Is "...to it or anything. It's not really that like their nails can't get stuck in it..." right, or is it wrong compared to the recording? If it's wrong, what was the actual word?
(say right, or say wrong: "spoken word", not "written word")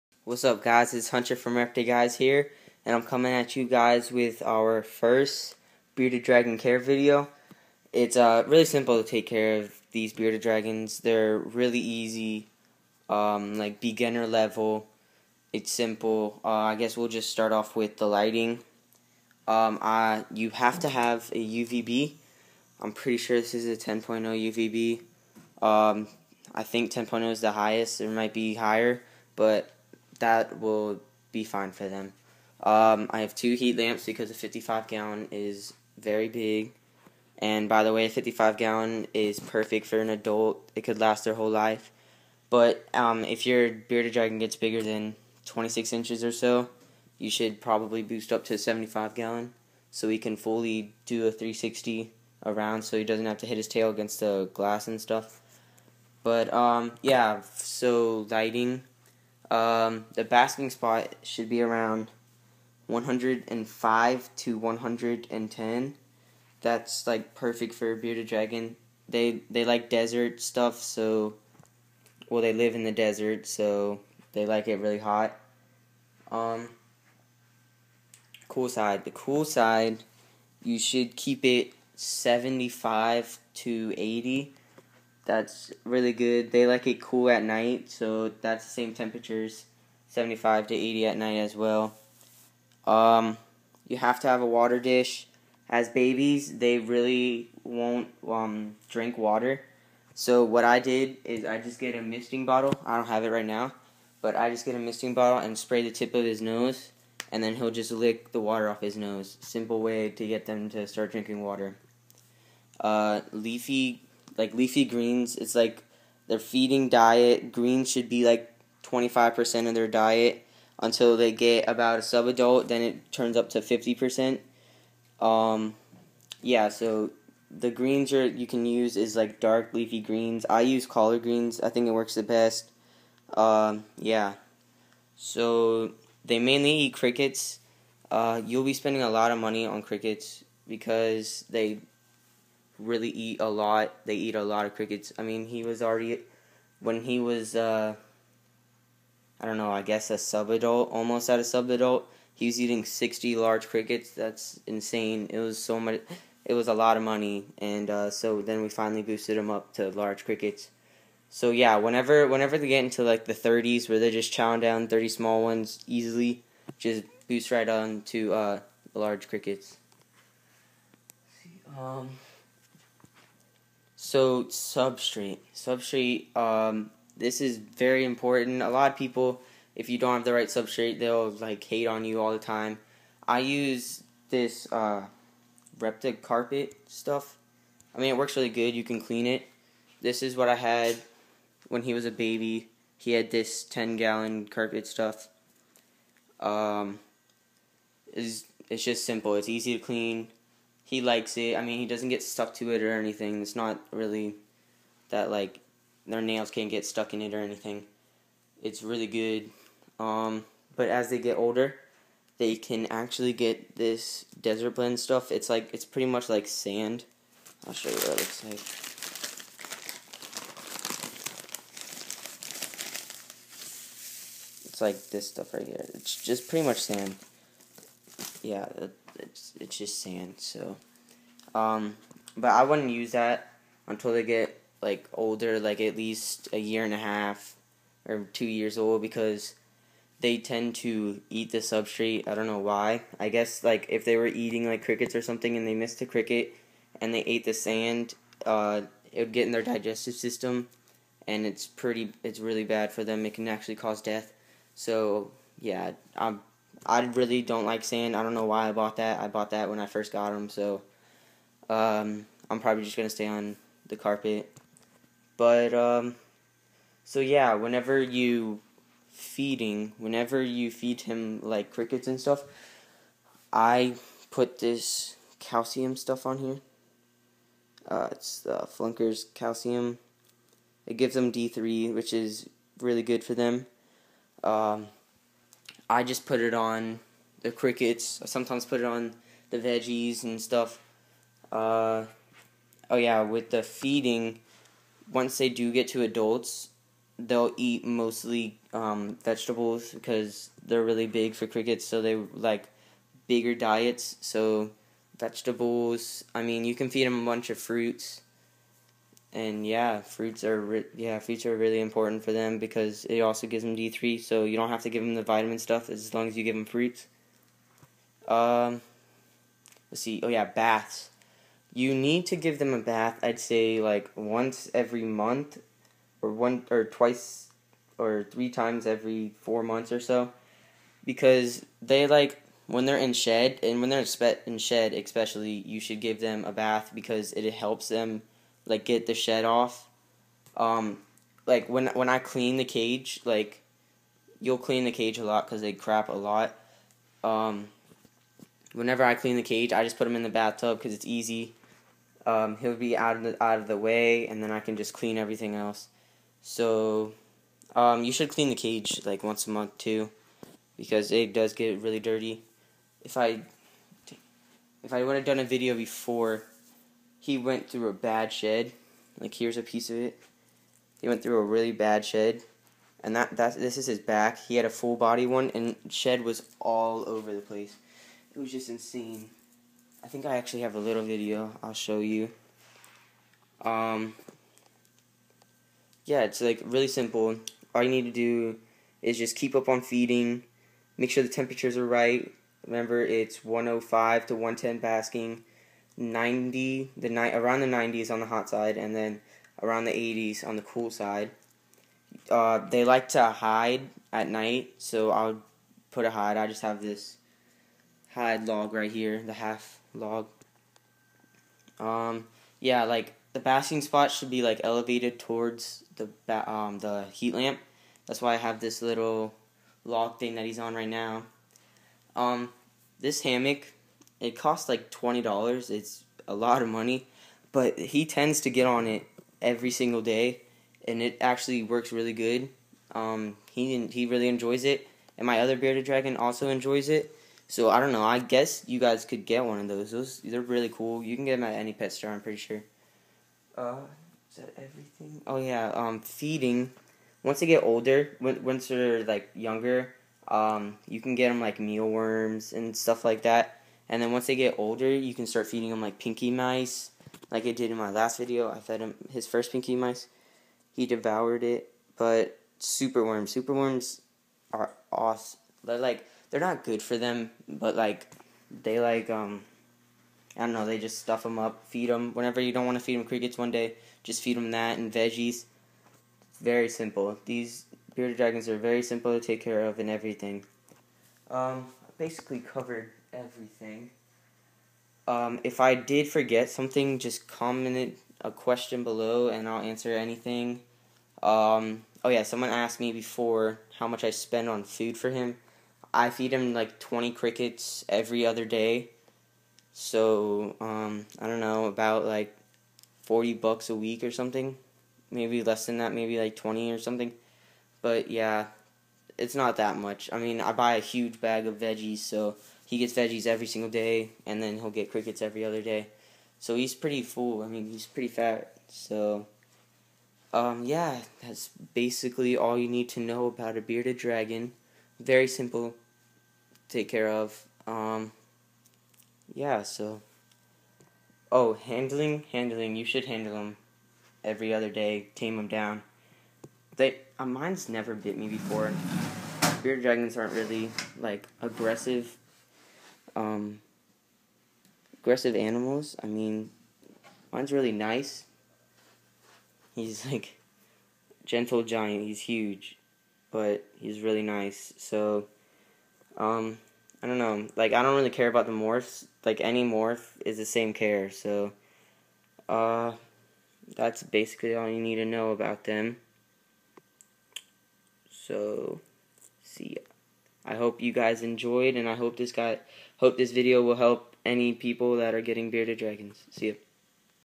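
right.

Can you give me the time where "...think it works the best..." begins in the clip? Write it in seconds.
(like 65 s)
131 s.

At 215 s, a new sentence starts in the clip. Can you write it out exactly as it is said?
It's like it's pretty much like sand.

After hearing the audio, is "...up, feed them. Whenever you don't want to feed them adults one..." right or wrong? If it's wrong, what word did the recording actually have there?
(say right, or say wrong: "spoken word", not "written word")
wrong: "crickets", not "adults".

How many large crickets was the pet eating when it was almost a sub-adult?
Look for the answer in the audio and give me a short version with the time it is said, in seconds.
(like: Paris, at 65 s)
60, at 152 s.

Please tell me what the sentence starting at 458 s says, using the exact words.
I fed him his first pinky mice.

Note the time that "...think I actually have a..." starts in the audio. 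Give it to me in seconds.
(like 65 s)
380 s.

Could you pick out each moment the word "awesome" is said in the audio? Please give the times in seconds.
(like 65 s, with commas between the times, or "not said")
464 s.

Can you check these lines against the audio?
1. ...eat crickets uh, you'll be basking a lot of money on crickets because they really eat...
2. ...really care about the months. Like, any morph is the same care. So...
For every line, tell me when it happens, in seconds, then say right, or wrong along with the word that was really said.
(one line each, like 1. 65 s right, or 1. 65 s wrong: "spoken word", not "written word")
1. 136 s wrong: "spending", not "basking"
2. 557 s wrong: "morphs", not "months".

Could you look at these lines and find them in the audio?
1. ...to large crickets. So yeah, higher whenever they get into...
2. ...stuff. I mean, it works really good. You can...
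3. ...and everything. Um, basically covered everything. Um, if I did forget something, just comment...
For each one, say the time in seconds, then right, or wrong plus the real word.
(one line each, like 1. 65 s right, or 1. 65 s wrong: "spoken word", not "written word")
1. 159 s wrong: "whenever", not "higher"
2. 186 s right
3. 479 s right.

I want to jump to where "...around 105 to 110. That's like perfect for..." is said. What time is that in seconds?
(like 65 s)
61 s.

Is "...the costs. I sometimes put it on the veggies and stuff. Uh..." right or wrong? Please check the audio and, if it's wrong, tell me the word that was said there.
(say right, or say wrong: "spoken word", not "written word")
wrong: "crickets", not "costs".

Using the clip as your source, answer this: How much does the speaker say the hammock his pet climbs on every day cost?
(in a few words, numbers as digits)
$20.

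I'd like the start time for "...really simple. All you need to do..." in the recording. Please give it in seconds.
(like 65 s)
386 s.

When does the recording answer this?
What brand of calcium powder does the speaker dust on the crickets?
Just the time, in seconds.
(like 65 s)
278 s.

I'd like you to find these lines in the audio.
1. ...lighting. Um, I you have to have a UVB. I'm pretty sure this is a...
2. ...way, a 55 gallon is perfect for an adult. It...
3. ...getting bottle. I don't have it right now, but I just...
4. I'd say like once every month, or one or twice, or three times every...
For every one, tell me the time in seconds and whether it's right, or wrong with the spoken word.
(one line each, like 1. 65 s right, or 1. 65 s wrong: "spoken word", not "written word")
1. 18 s right
2. 37 s right
3. 102 s wrong: "misting", not "getting"
4. 323 s right.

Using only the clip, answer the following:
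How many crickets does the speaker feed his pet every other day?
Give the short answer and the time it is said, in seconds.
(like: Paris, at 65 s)
20, at 496 s.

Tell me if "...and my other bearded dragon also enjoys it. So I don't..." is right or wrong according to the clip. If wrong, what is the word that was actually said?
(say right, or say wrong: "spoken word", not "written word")
right.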